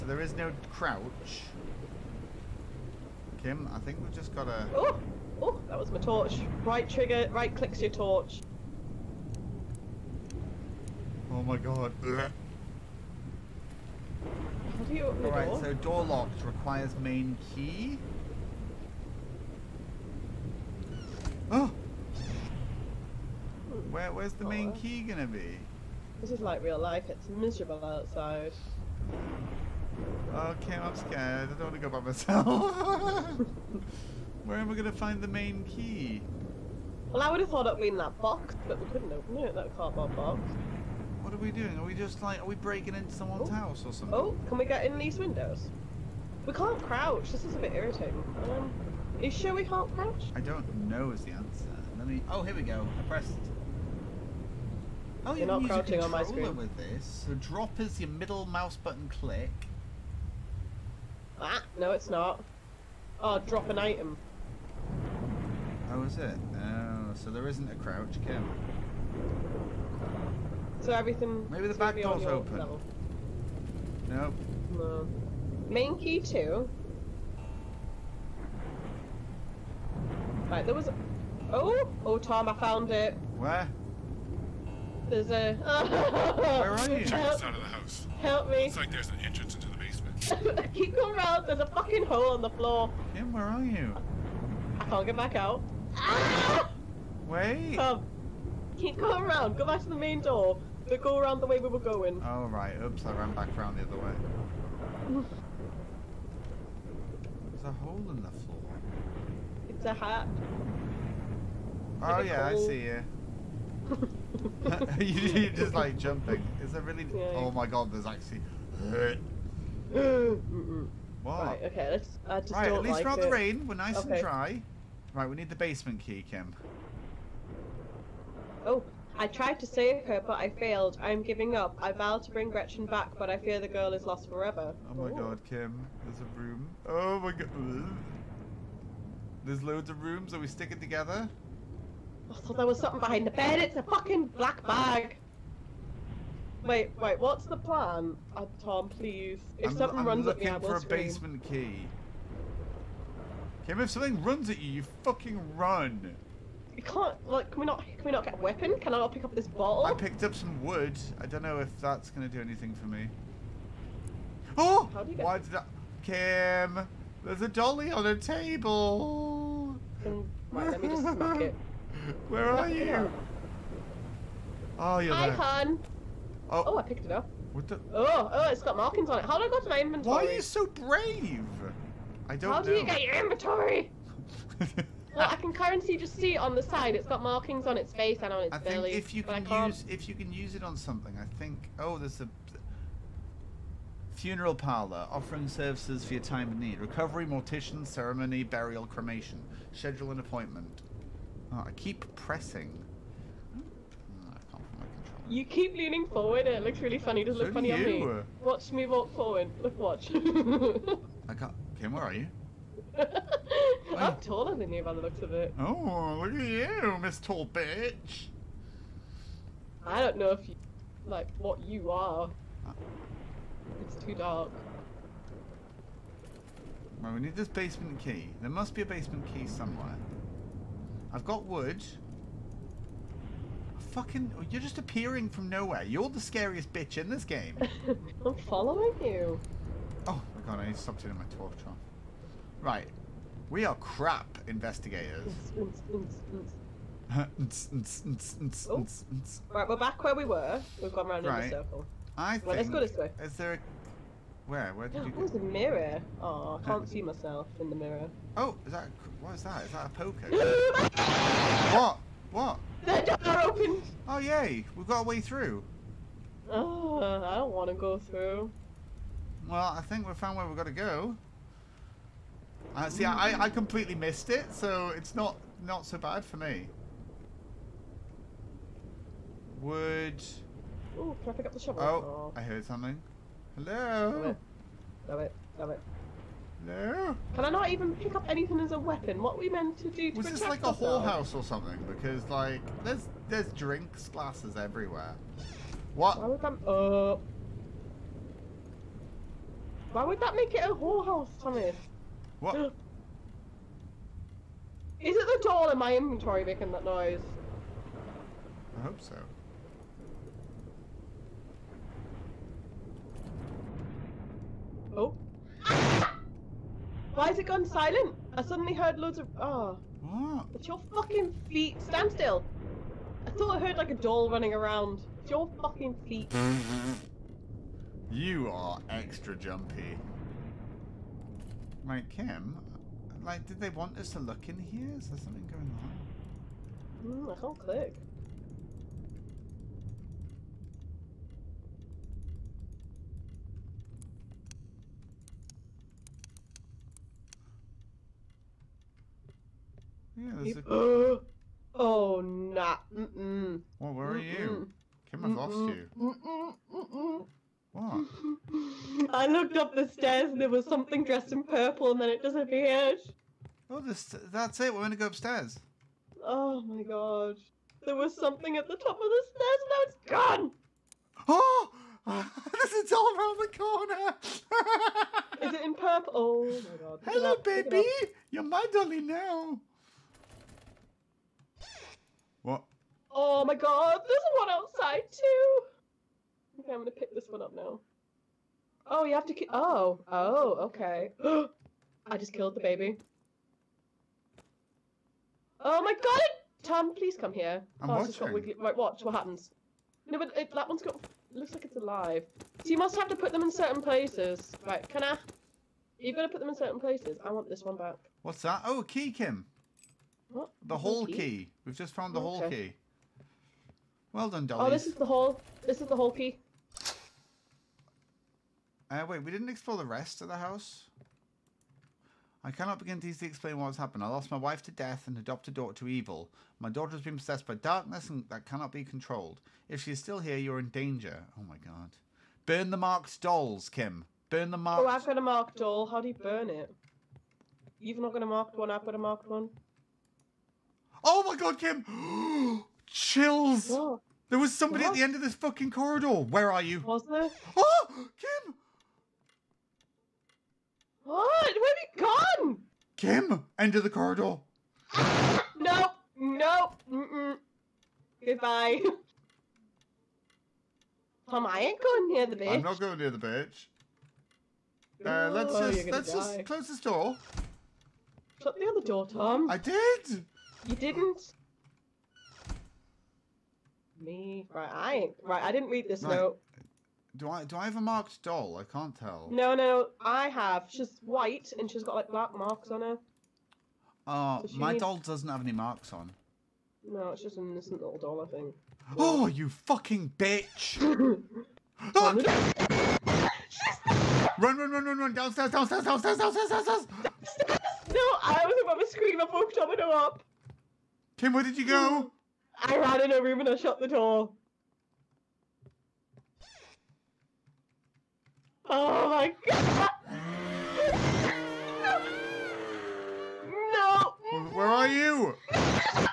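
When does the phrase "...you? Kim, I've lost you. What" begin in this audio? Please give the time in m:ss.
5:54.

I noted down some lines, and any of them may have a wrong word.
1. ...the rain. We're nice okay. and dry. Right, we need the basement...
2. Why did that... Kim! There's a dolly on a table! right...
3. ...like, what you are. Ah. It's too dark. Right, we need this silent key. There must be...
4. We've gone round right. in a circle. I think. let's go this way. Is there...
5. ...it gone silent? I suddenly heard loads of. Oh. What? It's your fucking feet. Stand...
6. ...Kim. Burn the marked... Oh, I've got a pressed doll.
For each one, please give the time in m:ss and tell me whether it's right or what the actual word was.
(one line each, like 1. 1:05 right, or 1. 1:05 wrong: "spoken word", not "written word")
1. 2:03 right
2. 2:45 right
3. 3:41 wrong: "basement", not "silent"
4. 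4:10 right
5. 5:17 right
6. 7:13 wrong: "marked", not "pressed".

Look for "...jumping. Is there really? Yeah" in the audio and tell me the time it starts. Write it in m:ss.
1:55.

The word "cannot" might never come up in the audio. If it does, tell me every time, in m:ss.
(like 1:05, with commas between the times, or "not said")
7:02, 7:08.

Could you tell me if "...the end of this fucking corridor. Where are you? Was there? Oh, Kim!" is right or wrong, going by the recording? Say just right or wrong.
right.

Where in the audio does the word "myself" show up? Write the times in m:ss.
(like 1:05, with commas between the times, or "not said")
0:31, 4:17.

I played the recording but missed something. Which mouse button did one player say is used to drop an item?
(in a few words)
Middle mouse button.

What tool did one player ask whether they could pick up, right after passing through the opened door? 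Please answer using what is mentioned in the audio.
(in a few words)
Shovel.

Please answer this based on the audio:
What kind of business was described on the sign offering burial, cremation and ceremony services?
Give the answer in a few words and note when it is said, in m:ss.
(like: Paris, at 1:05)
Funeral parlor, at 3:14.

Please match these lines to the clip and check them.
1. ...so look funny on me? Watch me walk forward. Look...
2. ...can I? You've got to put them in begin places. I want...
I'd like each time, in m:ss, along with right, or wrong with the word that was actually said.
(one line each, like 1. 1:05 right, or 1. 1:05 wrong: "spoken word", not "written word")
1. 3:27 right
2. 6:44 wrong: "certain", not "begin".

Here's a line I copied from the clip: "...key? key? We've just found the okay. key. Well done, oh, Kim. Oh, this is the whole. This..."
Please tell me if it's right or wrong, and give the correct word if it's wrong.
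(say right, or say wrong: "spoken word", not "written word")
wrong: "Dolly", not "Kim".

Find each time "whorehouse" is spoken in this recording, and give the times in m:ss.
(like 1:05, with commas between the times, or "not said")
4:50, 5:00.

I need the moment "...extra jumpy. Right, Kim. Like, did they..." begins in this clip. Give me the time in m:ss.
5:28.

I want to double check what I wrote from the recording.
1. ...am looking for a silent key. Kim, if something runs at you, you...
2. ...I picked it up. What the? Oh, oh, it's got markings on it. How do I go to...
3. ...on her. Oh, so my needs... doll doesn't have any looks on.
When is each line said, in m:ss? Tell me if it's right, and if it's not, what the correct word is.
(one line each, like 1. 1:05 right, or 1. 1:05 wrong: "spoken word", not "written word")
1. 2:30 wrong: "basement", not "silent"
2. 2:56 right
3. 8:02 wrong: "marks", not "looks".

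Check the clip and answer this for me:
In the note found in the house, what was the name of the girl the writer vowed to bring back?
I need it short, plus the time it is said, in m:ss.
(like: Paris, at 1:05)
Gretchen, at 2:12.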